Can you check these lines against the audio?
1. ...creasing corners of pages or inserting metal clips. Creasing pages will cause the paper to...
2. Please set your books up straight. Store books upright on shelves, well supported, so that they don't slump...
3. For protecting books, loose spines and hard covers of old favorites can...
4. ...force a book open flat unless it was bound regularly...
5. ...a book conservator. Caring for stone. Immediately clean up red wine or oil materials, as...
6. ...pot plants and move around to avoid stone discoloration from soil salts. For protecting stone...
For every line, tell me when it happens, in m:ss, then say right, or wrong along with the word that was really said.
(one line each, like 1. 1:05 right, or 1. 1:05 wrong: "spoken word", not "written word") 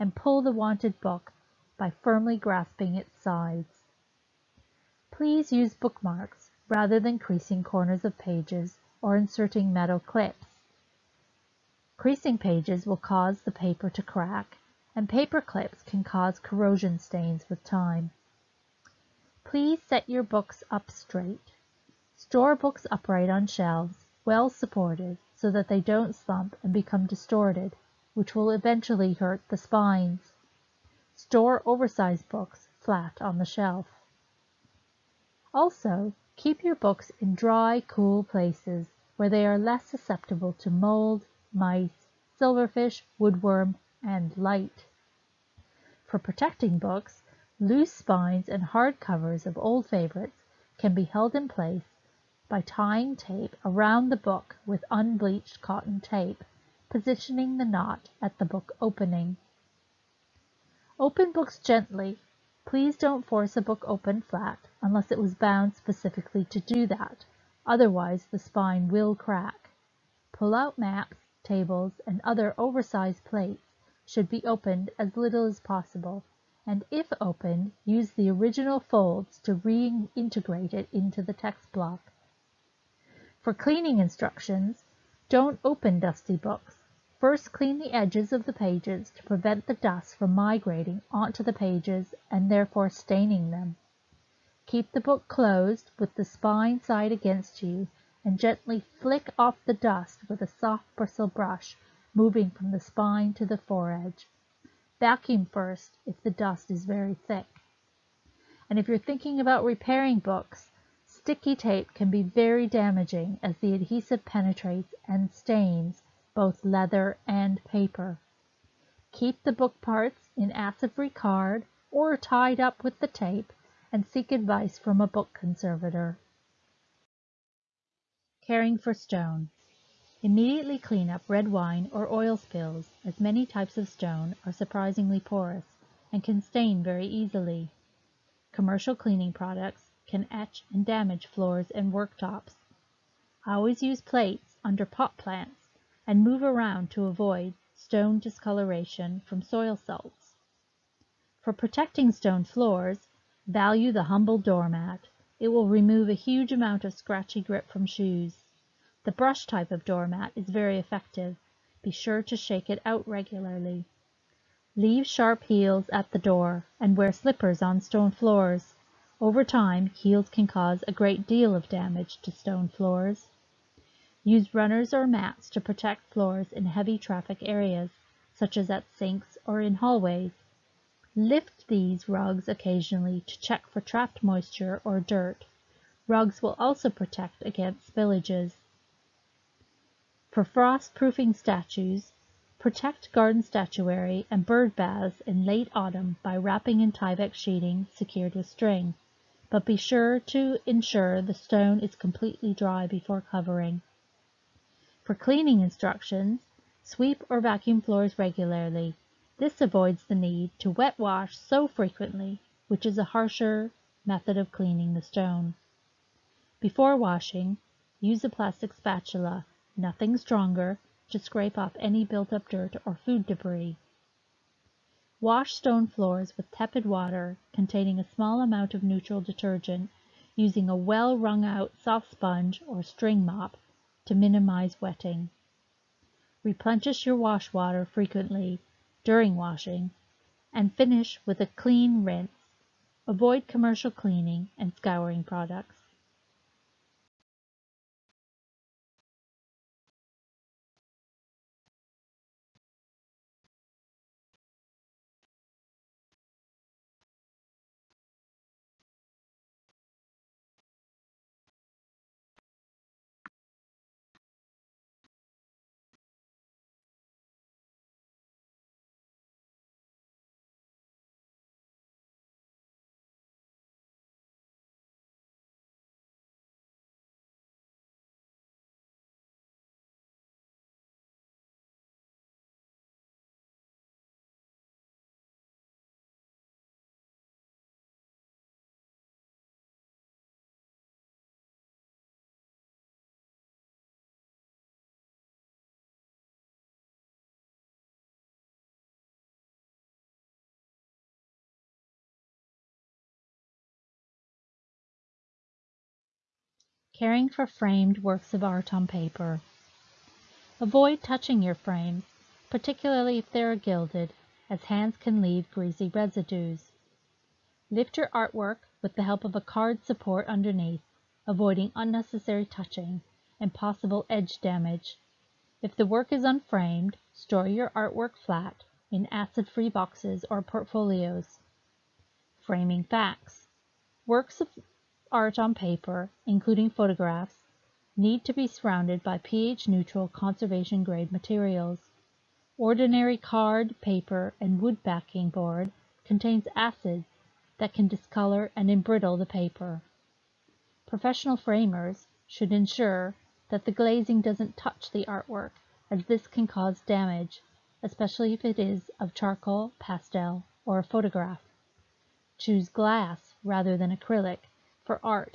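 1. 0:07 right
2. 0:19 right
3. 0:46 right
4. 1:03 wrong: "specifically", not "regularly"
5. 2:04 wrong: "spills", not "materials"
6. 2:24 right.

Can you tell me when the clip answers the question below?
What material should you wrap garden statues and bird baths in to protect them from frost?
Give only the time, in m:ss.
3:16.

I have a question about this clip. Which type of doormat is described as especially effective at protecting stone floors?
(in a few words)
brush type.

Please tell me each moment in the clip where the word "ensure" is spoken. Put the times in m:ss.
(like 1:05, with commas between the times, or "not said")
3:20, 5:52.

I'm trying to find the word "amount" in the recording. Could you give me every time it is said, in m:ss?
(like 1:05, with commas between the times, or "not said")
2:36, 3:48.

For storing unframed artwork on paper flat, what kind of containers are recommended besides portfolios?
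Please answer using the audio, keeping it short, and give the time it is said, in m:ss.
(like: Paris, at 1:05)
acid-free boxes, at 5:29.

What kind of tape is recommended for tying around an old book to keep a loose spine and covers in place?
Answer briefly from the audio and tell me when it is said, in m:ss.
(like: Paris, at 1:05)
unbleached cotton tape, at 0:54.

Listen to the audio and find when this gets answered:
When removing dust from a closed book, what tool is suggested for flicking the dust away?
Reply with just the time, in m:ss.
1:40.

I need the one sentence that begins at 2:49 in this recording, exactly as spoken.
Over time, heels can cause a great deal of damage to stone floors.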